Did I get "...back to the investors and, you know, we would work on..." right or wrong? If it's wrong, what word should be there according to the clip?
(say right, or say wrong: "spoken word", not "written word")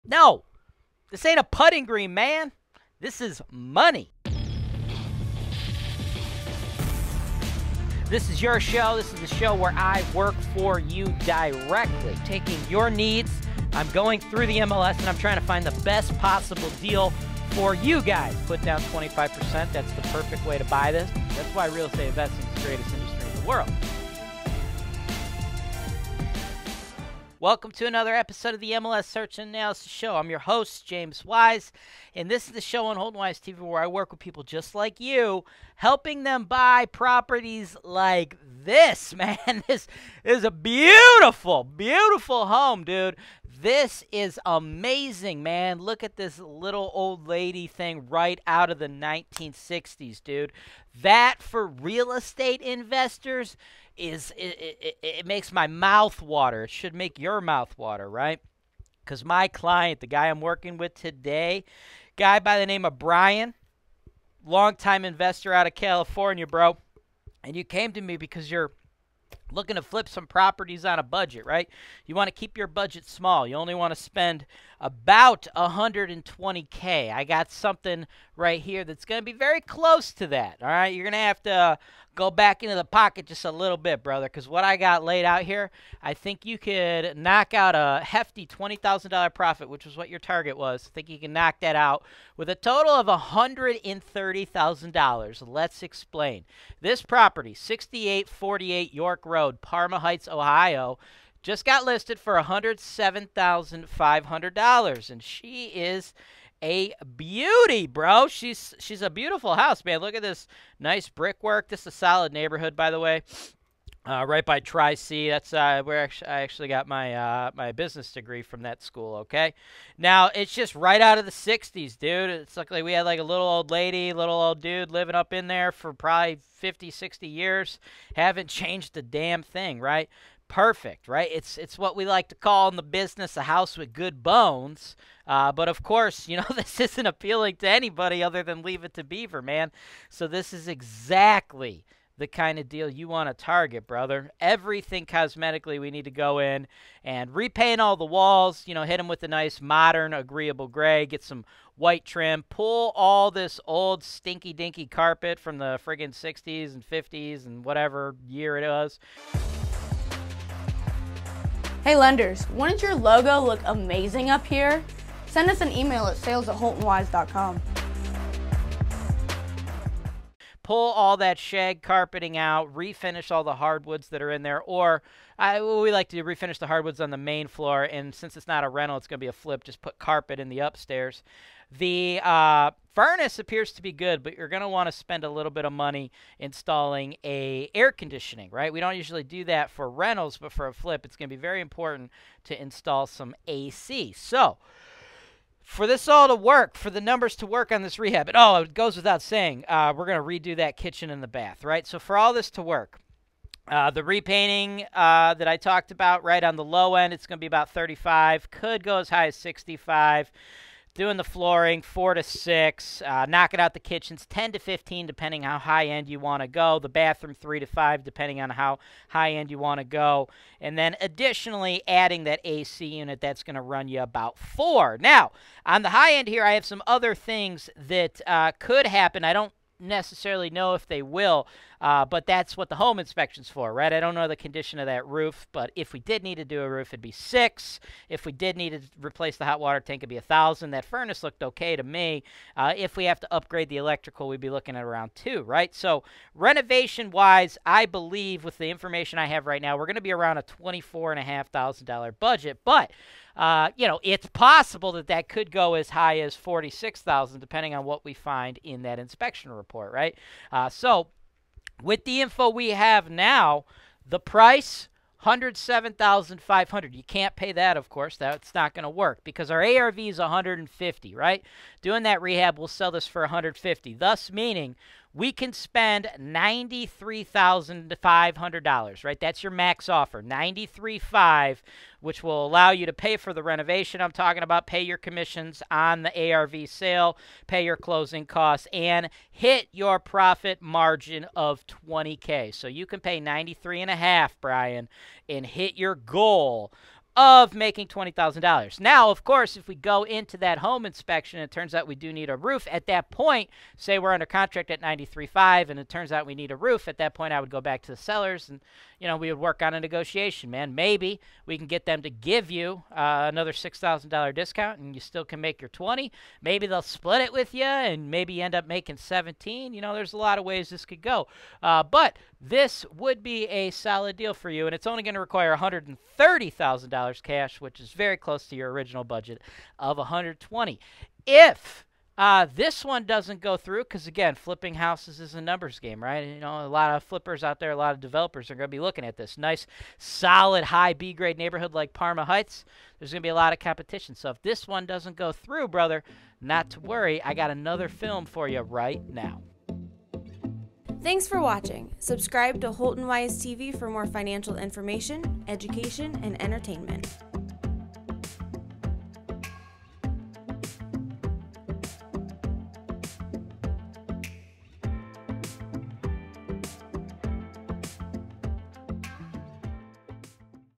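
wrong: "sellers", not "investors".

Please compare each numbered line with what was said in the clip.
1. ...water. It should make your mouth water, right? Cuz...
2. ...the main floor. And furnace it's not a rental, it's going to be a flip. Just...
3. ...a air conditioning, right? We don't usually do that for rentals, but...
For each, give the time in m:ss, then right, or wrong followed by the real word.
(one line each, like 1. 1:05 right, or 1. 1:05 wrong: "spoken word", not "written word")
1. 0:56 right
2. 2:57 wrong: "since", not "furnace"
3. 3:07 right.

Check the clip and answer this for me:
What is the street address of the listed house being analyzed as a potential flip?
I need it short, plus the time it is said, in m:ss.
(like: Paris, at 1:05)
6848 York Road, at 1:37.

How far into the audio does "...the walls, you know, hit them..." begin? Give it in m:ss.
2:27.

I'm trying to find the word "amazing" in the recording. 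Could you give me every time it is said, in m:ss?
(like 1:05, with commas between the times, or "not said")
0:44, 2:43.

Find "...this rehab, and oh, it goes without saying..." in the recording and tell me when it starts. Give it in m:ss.
3:17.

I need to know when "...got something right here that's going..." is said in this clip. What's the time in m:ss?
1:17.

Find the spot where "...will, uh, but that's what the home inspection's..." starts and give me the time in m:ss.
3:51.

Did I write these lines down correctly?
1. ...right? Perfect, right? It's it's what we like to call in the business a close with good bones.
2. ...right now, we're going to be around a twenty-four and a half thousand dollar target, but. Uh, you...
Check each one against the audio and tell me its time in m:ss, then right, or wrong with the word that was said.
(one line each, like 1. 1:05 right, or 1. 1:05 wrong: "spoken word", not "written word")
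1. 2:09 wrong: "house", not "close"
2. 4:09 wrong: "budget", not "target".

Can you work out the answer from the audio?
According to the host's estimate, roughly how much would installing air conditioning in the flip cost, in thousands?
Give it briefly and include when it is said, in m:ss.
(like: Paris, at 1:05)
4, at 3:44.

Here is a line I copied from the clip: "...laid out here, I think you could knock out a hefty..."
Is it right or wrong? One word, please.
right.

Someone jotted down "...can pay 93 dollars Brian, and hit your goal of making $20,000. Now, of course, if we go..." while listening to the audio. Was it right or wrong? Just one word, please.
right.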